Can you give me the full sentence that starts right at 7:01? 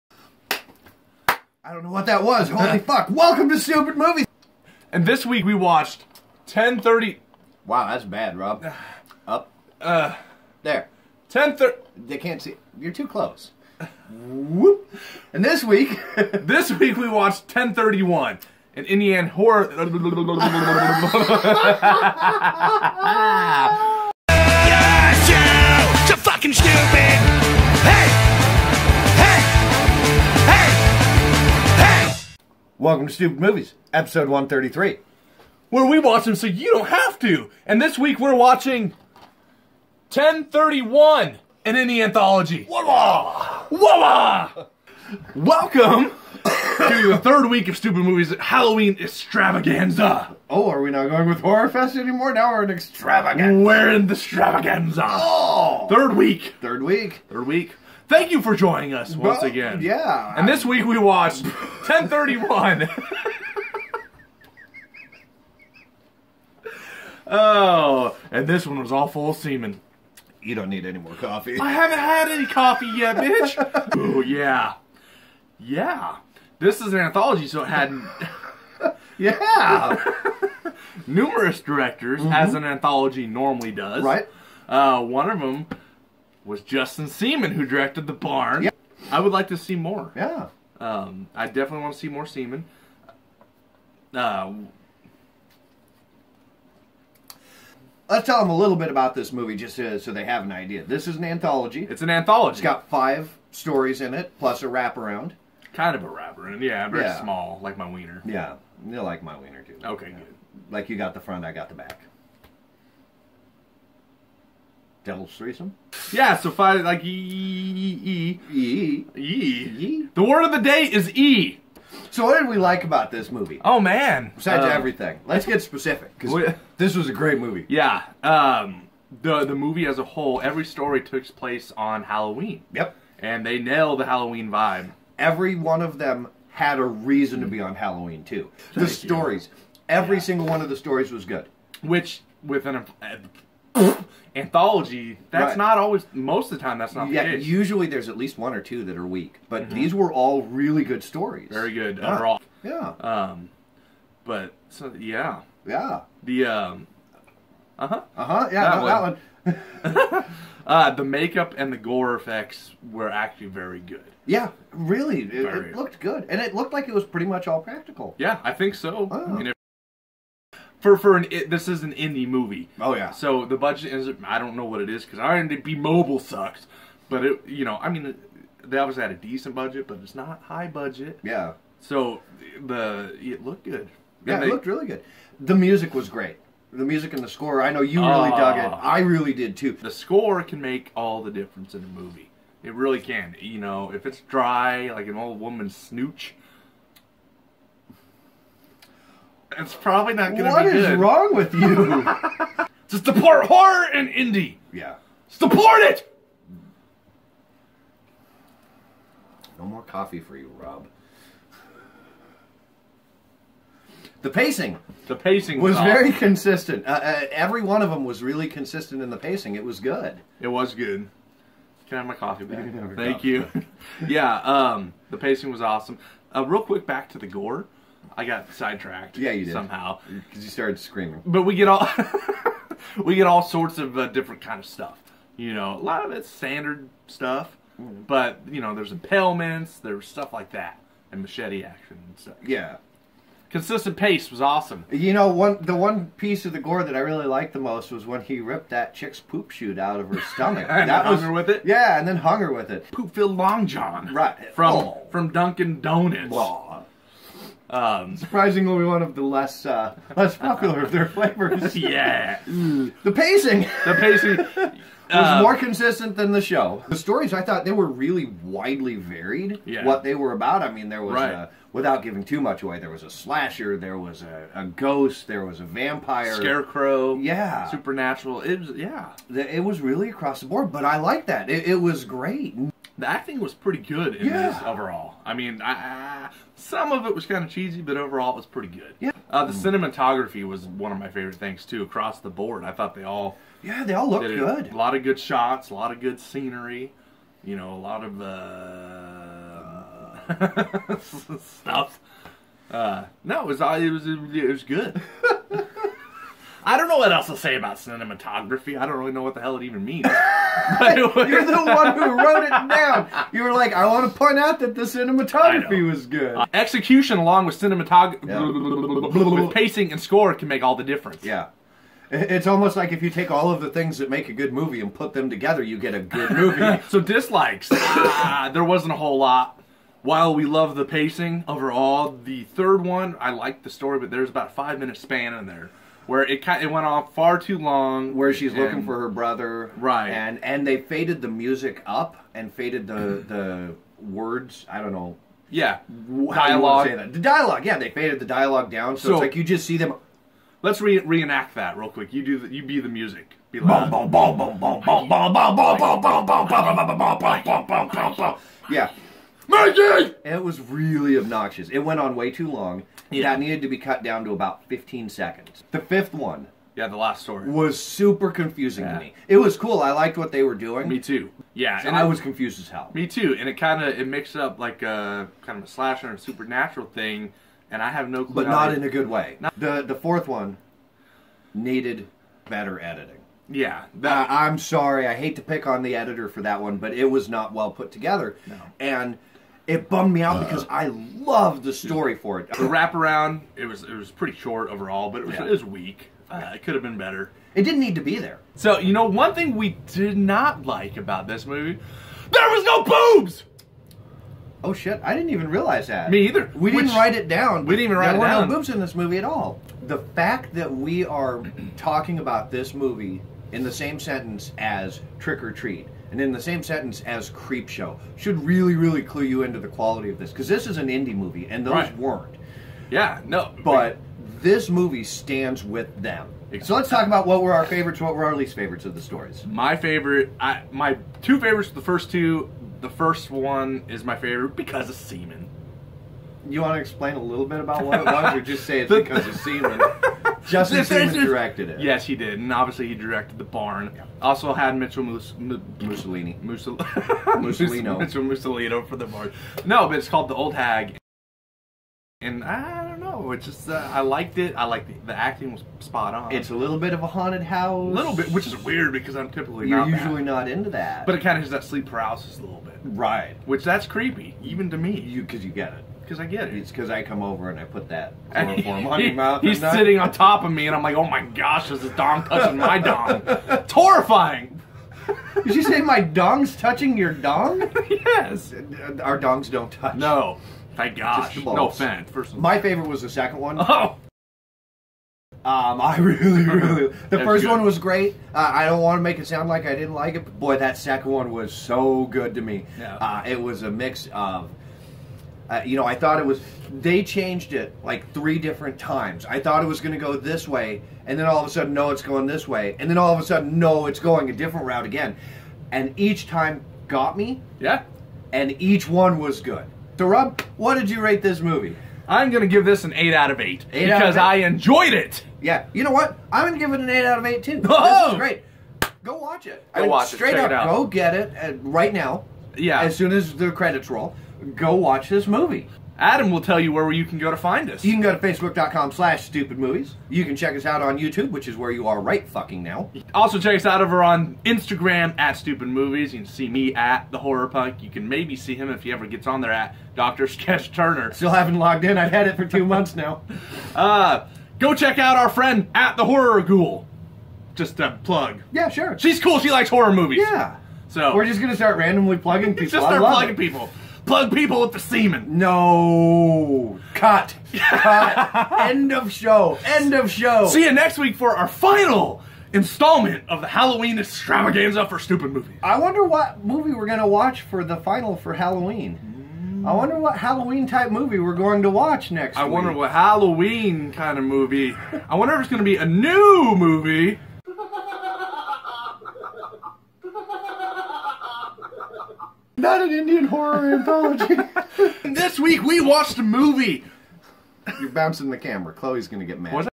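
weren't yeah no but this movie stands with them exactly.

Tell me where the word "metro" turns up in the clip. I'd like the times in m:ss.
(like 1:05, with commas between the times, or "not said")
not said.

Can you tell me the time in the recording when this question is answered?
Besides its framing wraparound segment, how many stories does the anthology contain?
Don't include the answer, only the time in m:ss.
1:42.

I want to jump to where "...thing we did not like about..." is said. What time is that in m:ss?
6:39.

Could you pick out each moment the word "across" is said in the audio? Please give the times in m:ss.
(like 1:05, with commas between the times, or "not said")
4:40, 4:51.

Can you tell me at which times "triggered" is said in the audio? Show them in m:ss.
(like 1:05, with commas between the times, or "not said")
not said.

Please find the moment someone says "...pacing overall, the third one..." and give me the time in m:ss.
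5:30.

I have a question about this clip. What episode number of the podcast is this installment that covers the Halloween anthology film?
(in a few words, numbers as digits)
133.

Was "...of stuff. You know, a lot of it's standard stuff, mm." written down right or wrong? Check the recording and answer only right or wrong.
right.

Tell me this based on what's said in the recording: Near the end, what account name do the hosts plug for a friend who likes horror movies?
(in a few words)
The Horror Ghoul.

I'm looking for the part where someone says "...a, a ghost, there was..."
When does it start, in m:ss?
4:34.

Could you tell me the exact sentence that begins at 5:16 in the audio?
Uh, execution along with cinematography, yeah.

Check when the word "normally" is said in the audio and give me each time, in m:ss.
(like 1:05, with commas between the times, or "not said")
1:23.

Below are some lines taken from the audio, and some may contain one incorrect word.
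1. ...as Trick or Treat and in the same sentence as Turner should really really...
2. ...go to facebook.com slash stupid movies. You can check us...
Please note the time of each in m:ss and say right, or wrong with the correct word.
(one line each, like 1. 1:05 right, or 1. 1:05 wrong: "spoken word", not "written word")
1. 6:54 wrong: "Creepshow", not "Turner"
2. 8:48 right.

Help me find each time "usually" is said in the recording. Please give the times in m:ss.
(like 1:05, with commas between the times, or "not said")
2:27, 7:40.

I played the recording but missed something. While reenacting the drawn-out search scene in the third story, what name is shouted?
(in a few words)
Mikey.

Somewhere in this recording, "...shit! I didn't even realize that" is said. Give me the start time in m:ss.
6:44.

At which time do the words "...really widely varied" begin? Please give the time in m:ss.
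4:27.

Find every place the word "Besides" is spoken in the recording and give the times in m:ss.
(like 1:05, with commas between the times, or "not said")
2:04.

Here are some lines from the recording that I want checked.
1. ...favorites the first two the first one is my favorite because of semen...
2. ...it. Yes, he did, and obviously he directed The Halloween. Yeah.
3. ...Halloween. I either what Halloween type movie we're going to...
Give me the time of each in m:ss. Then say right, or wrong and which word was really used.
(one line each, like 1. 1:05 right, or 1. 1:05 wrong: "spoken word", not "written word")
1. 7:11 right
2. 7:21 wrong: "Barn", not "Halloween"
3. 9:28 wrong: "wonder", not "either".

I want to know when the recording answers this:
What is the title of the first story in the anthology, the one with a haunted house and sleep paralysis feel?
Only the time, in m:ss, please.
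7:30.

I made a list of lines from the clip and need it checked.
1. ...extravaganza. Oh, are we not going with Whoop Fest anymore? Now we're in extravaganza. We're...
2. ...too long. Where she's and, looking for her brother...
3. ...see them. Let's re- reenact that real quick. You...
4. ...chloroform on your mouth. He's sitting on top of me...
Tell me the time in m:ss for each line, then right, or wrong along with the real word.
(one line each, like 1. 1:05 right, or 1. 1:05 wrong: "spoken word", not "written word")
1. 0:48 wrong: "Horror", not "Whoop"
2. 5:37 right
3. 5:49 right
4. 7:48 right.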